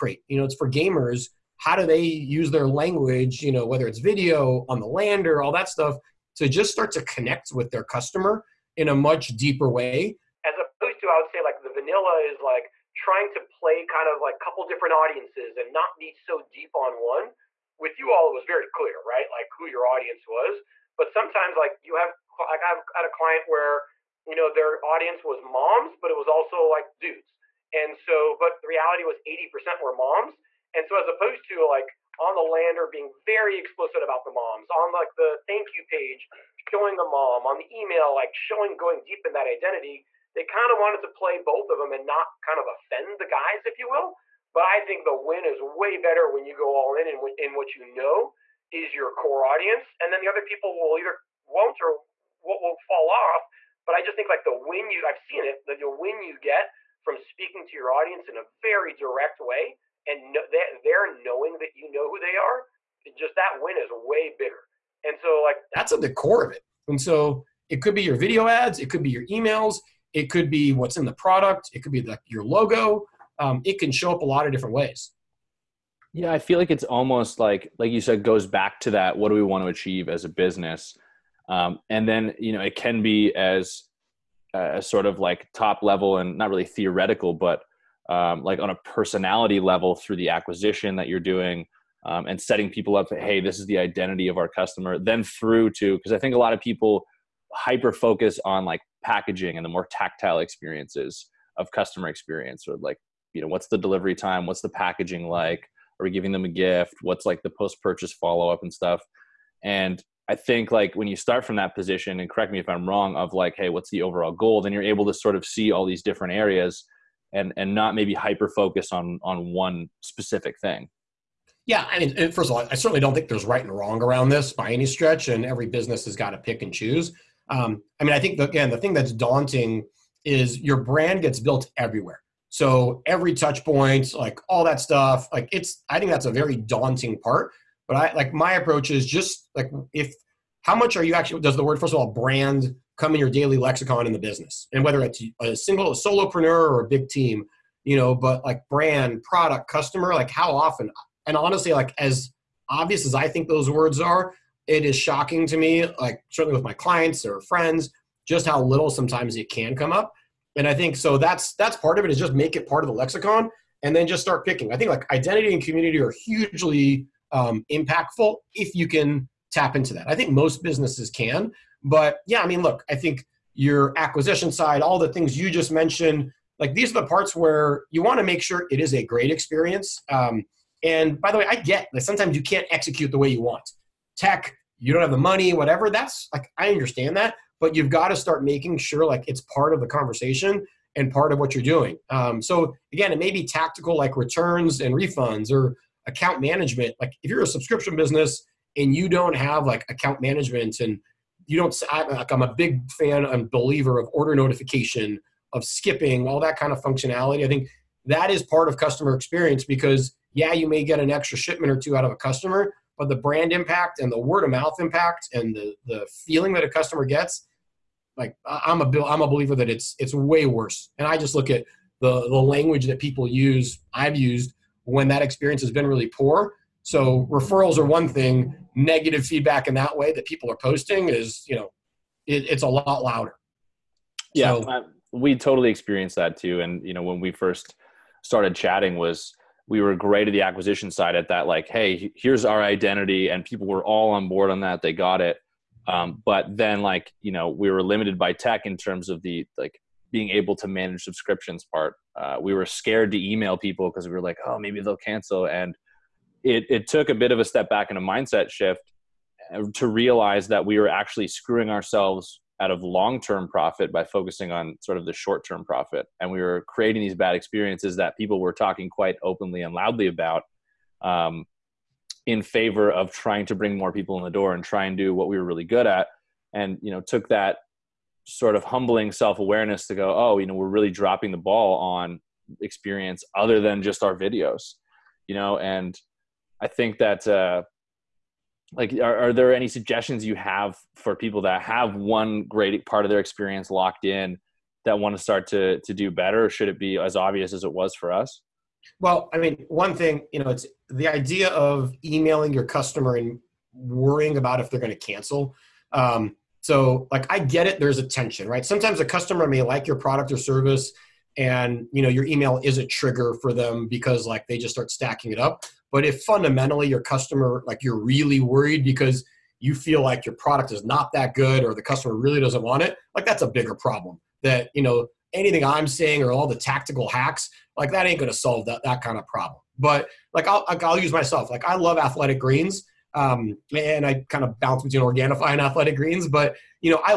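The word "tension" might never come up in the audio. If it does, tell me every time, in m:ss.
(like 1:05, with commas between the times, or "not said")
5:08.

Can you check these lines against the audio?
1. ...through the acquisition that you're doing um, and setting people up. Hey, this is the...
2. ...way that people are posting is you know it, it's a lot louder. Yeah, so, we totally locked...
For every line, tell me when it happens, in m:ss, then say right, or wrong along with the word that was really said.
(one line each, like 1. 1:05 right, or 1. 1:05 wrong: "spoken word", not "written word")
1. 1:29 right
2. 3:49 wrong: "experienced", not "locked".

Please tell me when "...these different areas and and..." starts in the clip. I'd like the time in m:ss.
1:55.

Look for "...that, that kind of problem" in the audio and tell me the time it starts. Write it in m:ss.
5:28.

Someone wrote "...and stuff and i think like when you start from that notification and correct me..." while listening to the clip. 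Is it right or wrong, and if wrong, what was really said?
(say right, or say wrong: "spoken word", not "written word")
wrong: "position", not "notification".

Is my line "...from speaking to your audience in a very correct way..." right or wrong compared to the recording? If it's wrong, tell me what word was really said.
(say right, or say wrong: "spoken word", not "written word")
wrong: "direct", not "correct".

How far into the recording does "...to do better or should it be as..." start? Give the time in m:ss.
4:55.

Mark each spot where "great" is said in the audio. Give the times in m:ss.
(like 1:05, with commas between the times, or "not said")
2:59, 3:59, 4:52.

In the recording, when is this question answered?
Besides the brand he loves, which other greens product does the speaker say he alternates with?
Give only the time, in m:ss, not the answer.
5:35.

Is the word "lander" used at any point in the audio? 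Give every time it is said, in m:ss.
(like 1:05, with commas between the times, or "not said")
0:04, 0:32.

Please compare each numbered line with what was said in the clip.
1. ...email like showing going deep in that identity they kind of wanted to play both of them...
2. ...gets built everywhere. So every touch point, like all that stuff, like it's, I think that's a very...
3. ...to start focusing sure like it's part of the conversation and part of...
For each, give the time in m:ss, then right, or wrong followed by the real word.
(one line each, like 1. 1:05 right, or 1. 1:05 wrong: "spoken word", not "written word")
1. 0:37 right
2. 2:11 right
3. 3:08 wrong: "making", not "focusing".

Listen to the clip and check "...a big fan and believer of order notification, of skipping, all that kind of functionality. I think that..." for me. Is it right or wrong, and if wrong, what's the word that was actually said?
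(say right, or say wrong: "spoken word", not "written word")
right.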